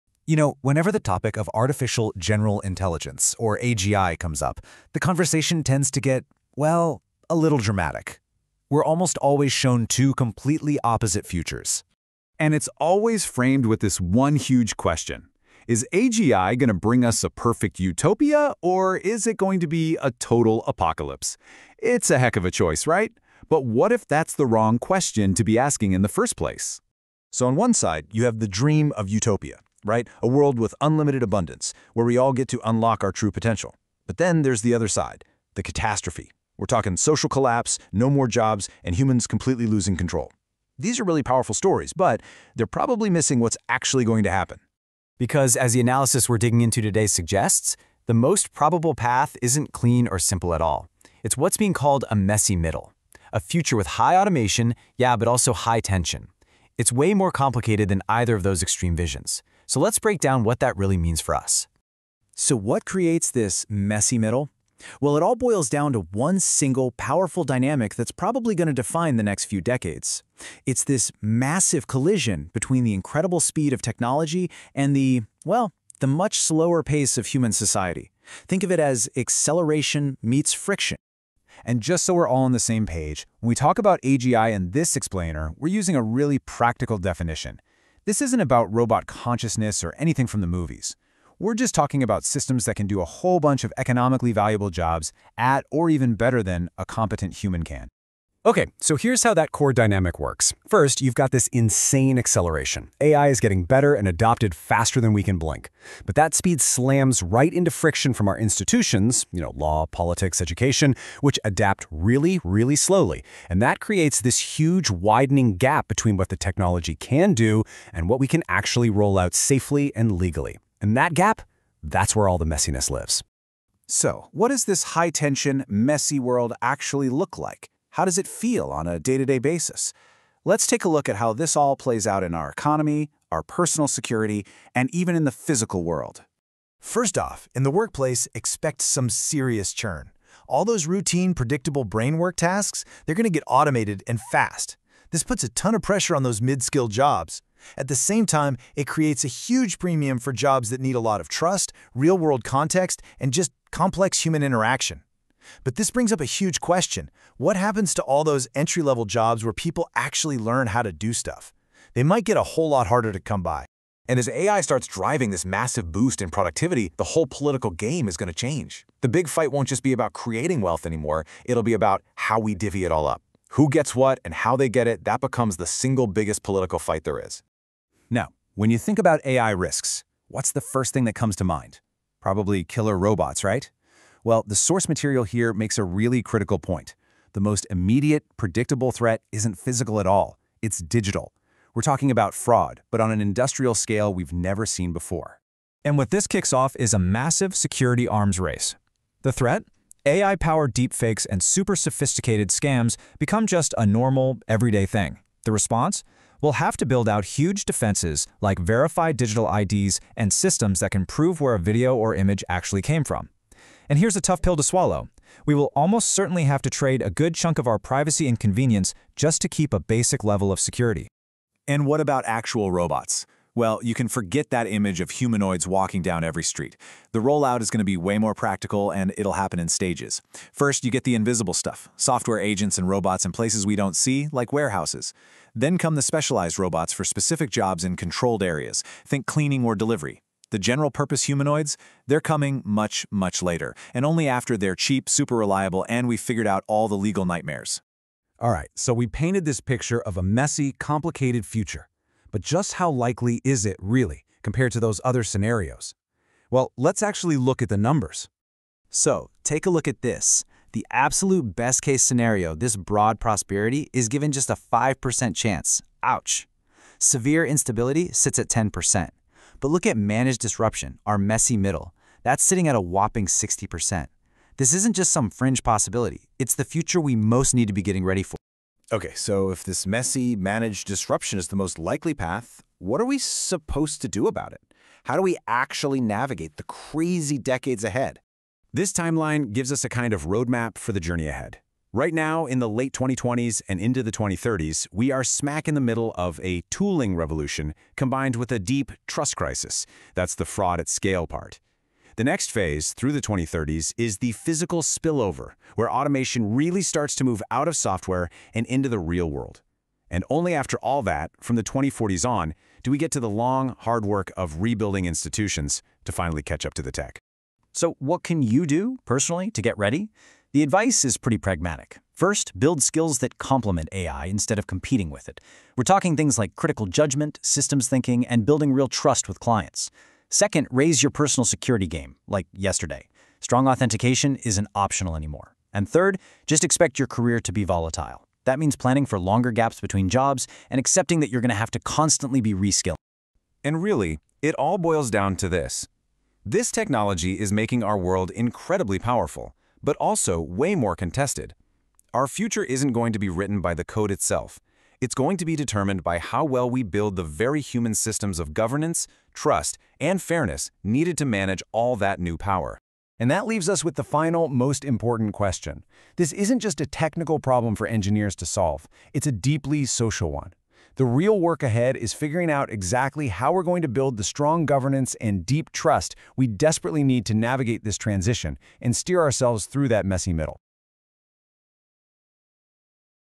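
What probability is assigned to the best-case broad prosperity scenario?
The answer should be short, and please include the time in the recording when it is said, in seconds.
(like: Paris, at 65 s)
5%, at 264 s.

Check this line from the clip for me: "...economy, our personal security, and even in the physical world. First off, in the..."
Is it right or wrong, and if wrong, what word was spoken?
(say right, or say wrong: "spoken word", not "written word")
right.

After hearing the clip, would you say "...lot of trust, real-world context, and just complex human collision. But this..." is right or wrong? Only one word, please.
wrong.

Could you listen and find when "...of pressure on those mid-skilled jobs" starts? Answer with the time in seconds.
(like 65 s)
145 s.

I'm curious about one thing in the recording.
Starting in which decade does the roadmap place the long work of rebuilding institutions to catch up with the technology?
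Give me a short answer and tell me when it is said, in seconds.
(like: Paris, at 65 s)
2040s, at 311 s.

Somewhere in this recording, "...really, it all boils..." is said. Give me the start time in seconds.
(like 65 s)
343 s.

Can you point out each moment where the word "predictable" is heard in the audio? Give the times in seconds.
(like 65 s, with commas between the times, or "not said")
141 s, 188 s.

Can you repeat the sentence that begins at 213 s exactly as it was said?
And here's a tough pill to swallow.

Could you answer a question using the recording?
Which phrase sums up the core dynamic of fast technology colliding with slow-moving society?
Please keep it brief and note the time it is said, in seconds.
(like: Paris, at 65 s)
Acceleration meets friction, at 79 s.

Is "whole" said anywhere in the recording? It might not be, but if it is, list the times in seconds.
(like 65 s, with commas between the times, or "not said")
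93 s, 162 s, 167 s.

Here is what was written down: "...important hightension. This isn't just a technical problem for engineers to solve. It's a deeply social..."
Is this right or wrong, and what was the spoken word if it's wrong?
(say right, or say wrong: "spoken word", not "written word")
wrong: "question", not "hightension".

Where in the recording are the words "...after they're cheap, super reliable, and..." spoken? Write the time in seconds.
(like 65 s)
244 s.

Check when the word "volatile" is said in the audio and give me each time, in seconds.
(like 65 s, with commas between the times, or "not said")
337 s.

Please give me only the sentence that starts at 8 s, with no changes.
We're almost always shown two completely opposite futures.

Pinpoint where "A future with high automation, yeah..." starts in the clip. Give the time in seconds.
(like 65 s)
53 s.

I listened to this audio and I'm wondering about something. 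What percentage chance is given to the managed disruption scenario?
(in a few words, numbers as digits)
60%.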